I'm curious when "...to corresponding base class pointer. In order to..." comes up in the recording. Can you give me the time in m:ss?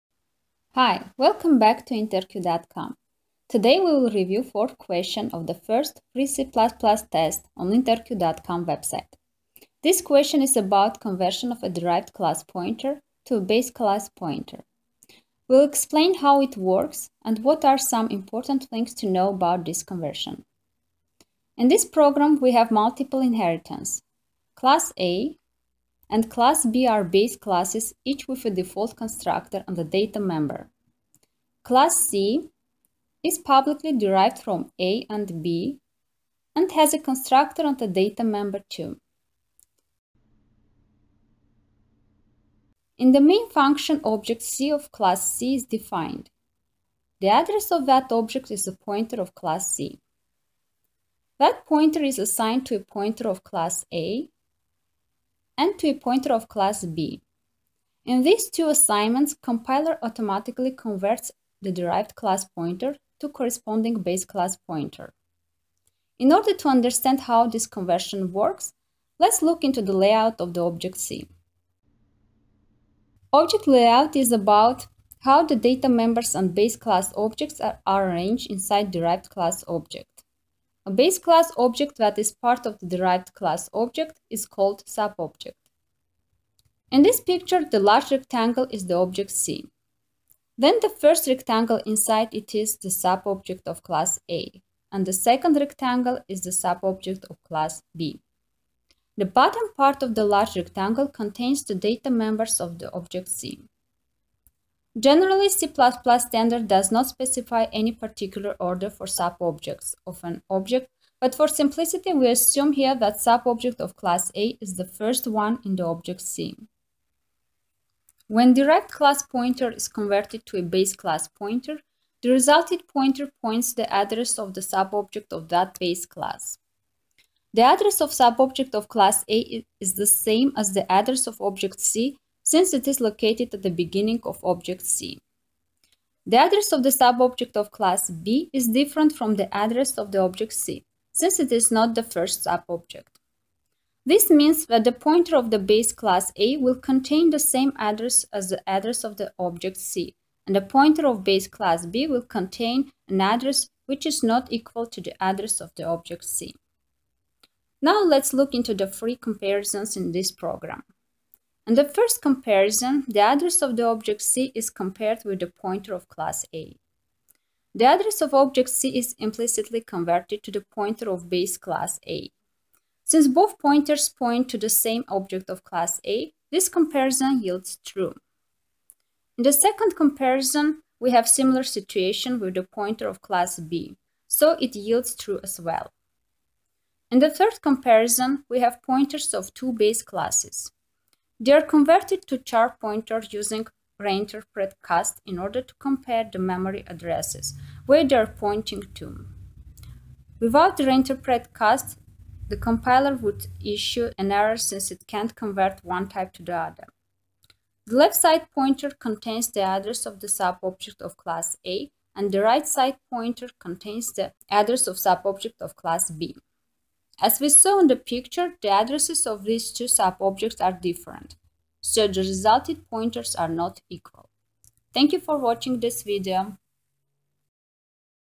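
1:03.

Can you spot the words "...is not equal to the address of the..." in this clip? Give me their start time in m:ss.
2:34.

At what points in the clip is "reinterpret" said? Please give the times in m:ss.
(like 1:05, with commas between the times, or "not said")
3:14, 3:20.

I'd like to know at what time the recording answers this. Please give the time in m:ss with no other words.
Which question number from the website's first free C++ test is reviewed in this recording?
0:04.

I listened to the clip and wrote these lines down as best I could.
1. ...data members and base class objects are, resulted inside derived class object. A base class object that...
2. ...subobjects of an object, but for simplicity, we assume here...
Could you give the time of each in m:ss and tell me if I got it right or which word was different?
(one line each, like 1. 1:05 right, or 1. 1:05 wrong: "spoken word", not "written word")
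1. 1:15 wrong: "arranged", not "resulted"
2. 1:49 right.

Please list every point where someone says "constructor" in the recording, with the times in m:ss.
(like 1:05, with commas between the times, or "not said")
0:28, 0:36.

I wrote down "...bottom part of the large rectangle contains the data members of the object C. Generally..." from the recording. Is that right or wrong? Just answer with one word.
right.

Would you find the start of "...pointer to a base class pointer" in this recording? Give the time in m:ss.
0:12.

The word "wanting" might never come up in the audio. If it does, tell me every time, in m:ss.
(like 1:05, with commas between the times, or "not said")
not said.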